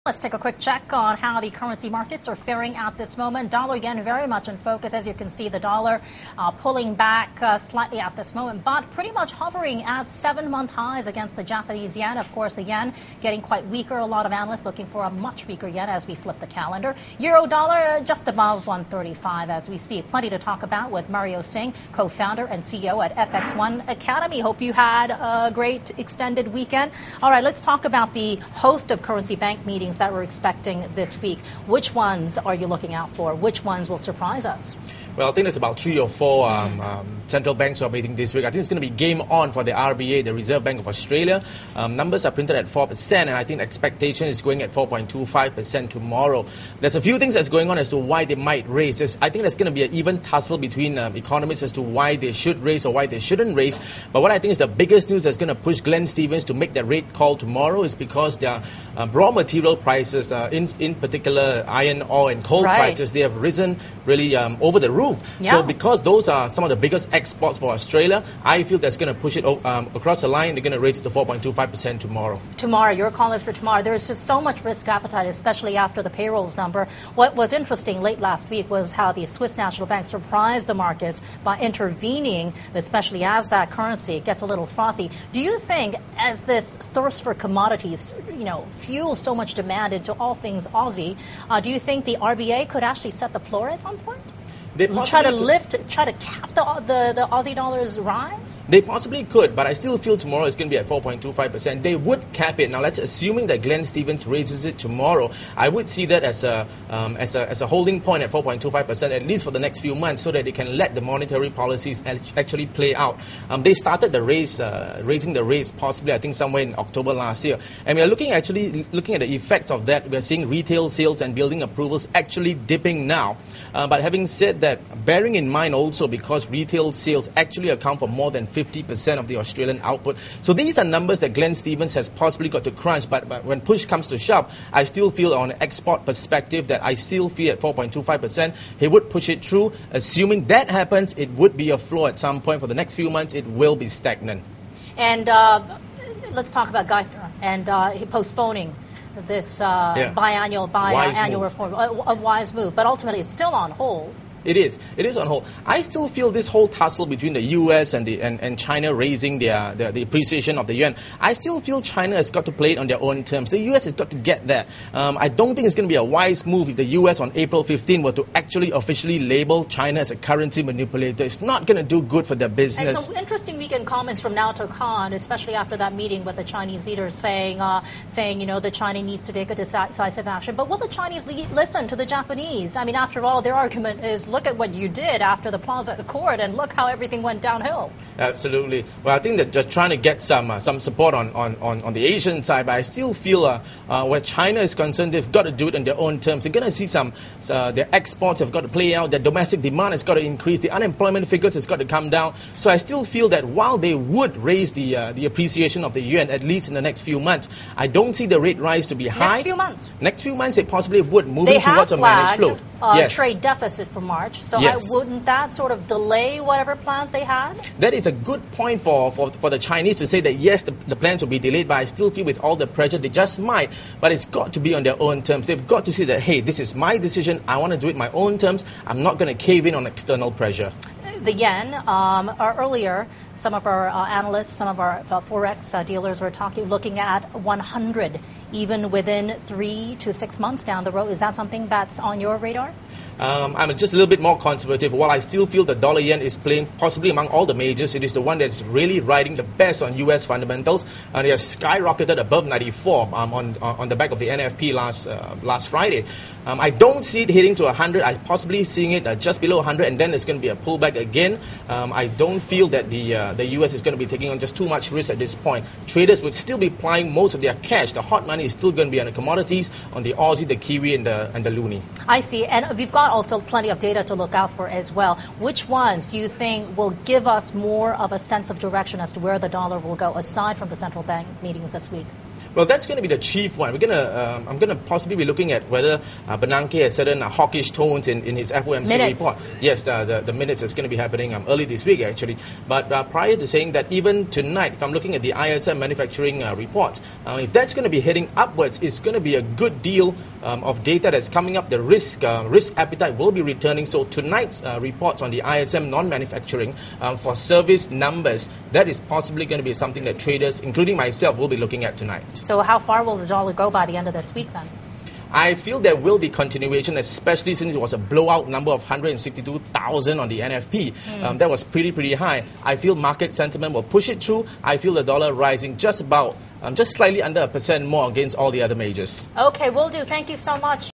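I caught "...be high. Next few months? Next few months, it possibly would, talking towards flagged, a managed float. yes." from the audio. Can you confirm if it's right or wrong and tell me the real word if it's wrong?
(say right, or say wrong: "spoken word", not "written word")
wrong: "moving", not "talking".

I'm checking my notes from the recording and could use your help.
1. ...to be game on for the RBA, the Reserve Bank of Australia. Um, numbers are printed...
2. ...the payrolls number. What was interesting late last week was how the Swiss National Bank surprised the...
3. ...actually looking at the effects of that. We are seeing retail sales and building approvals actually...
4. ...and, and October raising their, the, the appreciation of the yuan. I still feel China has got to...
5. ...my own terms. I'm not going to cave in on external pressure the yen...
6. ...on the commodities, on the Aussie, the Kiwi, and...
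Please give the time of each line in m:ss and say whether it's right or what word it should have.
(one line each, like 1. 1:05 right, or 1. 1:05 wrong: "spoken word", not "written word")
1. 0:38 right
2. 1:16 right
3. 1:58 right
4. 2:38 wrong: "China", not "October"
5. 3:47 right
6. 4:29 right.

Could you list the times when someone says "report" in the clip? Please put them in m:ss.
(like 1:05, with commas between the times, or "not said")
4:49, 4:56, 5:04.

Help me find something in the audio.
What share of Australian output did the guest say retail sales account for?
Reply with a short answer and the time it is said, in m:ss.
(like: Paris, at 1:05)
more than 50 percent, at 2:08.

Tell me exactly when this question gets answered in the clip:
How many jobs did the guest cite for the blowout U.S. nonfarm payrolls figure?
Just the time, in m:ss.
5:18.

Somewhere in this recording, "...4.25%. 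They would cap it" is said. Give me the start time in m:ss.
1:40.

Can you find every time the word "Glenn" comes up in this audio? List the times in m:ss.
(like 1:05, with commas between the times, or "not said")
0:55, 1:43, 2:11.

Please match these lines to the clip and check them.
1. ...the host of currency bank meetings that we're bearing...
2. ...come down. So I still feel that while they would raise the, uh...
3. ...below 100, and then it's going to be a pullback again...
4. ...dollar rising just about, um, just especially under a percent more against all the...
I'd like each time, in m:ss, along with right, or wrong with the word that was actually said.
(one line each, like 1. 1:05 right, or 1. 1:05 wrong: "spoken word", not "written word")
1. 0:28 wrong: "expecting", not "bearing"
2. 3:21 right
3. 4:19 right
4. 5:25 wrong: "slightly", not "especially".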